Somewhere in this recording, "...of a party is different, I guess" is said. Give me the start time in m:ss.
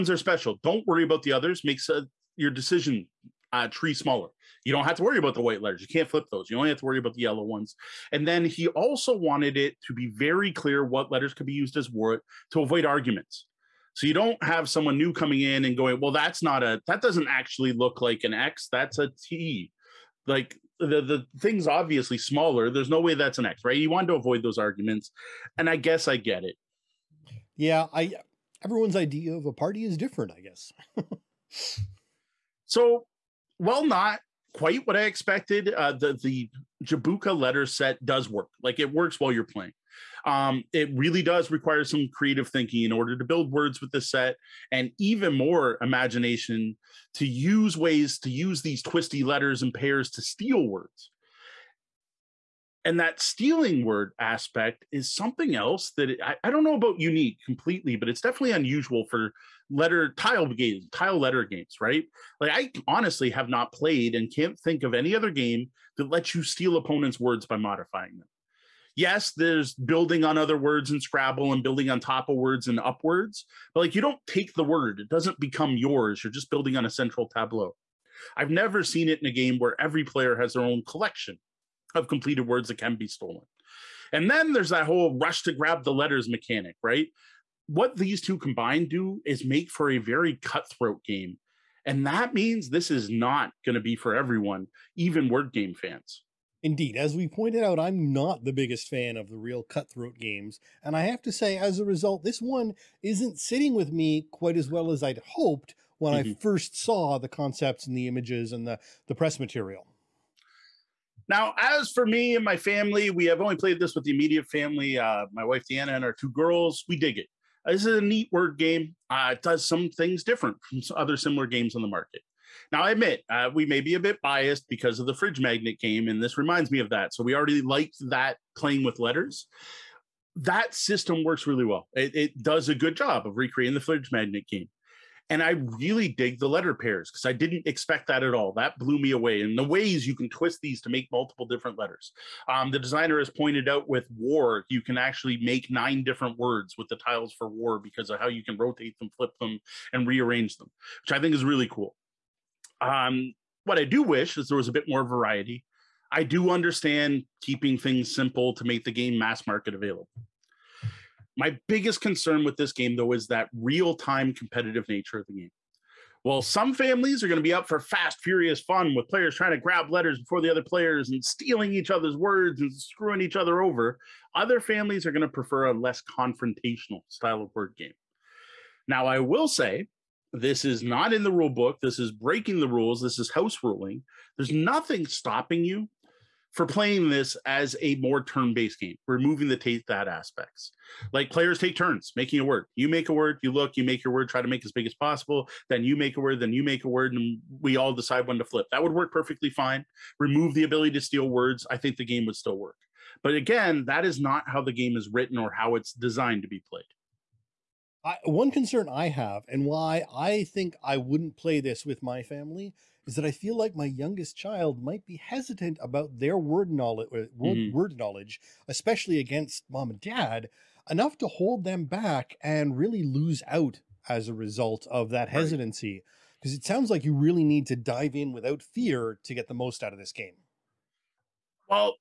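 0:29.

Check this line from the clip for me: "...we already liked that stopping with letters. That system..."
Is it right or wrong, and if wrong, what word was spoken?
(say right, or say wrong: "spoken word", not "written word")
wrong: "playing", not "stopping".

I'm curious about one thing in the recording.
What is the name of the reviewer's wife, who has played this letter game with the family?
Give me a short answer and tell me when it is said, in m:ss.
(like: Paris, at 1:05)
Deanna, at 1:55.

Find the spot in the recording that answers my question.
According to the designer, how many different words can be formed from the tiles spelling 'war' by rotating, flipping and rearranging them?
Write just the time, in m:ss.
2:25.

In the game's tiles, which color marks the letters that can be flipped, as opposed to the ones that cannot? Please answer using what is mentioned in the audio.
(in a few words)
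Yellow.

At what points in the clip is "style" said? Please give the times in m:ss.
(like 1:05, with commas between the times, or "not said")
2:57.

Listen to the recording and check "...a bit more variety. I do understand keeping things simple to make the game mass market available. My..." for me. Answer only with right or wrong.
right.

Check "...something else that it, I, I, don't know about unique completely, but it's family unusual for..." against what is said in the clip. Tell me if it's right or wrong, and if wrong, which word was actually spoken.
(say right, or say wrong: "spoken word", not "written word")
wrong: "definitely", not "family".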